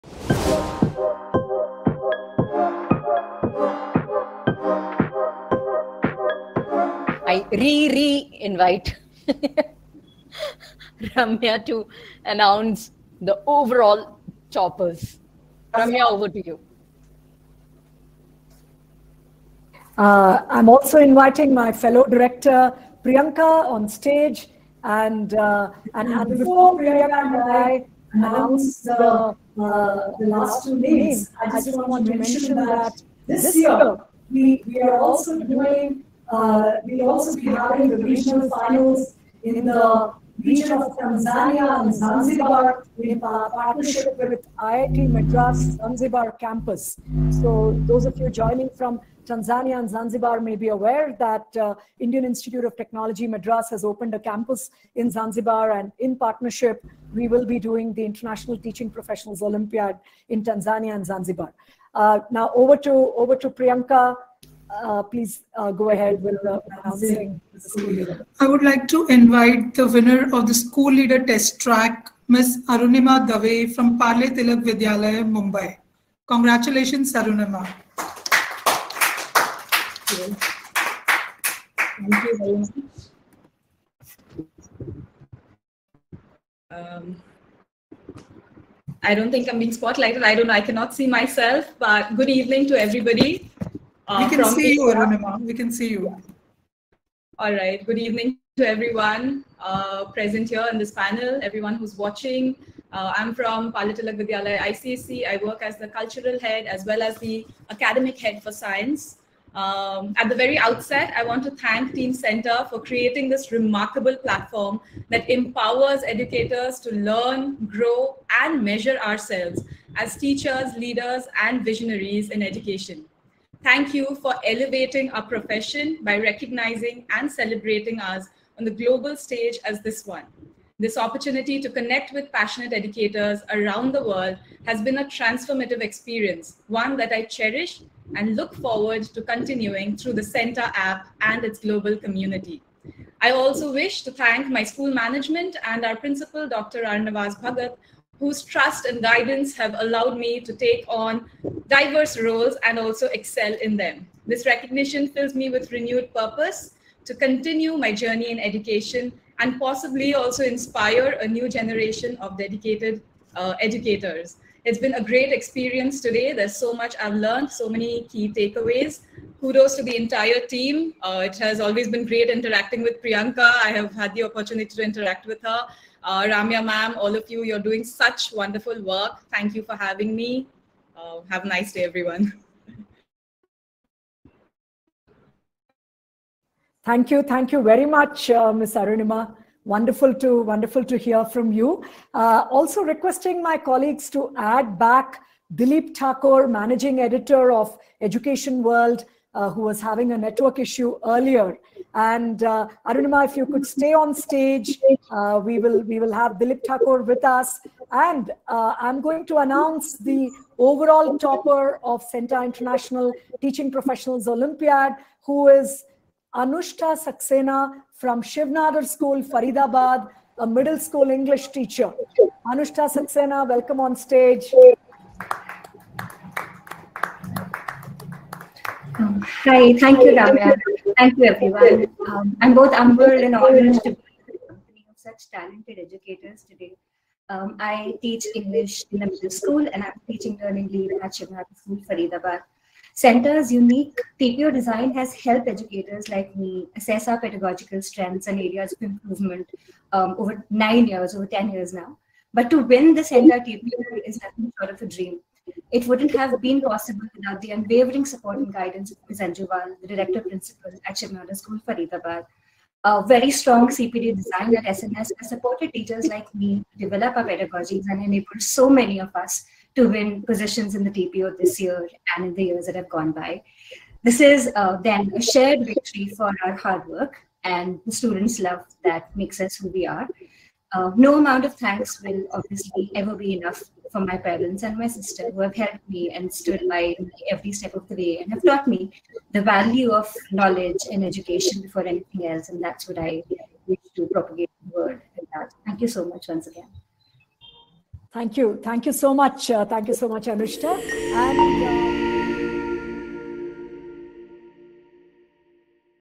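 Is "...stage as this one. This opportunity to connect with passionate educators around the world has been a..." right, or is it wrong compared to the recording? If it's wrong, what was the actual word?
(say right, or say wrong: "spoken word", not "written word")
right.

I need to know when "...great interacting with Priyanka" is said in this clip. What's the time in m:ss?
2:52.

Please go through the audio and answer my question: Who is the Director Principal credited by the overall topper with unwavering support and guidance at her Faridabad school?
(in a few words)
Anju Wal.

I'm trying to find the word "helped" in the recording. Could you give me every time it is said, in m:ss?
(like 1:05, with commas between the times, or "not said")
4:05, 4:45.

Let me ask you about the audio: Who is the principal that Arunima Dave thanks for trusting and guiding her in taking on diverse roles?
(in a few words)
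Dr. Arnavaz Bhagat.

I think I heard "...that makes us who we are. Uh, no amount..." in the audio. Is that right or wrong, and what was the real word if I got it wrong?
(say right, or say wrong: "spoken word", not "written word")
right.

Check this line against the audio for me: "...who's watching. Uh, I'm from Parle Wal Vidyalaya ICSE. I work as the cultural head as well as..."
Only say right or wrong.
wrong.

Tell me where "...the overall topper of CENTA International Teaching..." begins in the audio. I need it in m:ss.
3:29.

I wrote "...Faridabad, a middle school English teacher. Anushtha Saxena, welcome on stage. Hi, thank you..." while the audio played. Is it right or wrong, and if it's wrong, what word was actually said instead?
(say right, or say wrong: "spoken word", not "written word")
right.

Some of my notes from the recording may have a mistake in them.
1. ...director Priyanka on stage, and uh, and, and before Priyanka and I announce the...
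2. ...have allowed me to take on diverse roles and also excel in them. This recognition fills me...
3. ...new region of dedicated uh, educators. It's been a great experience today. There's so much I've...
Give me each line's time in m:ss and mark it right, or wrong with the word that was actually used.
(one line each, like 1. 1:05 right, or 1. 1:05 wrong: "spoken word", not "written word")
1. 0:22 right
2. 2:29 right
3. 2:41 wrong: "generation", not "region".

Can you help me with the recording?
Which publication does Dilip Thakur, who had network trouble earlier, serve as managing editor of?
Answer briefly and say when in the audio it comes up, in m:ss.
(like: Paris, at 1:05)
Education World, at 3:17.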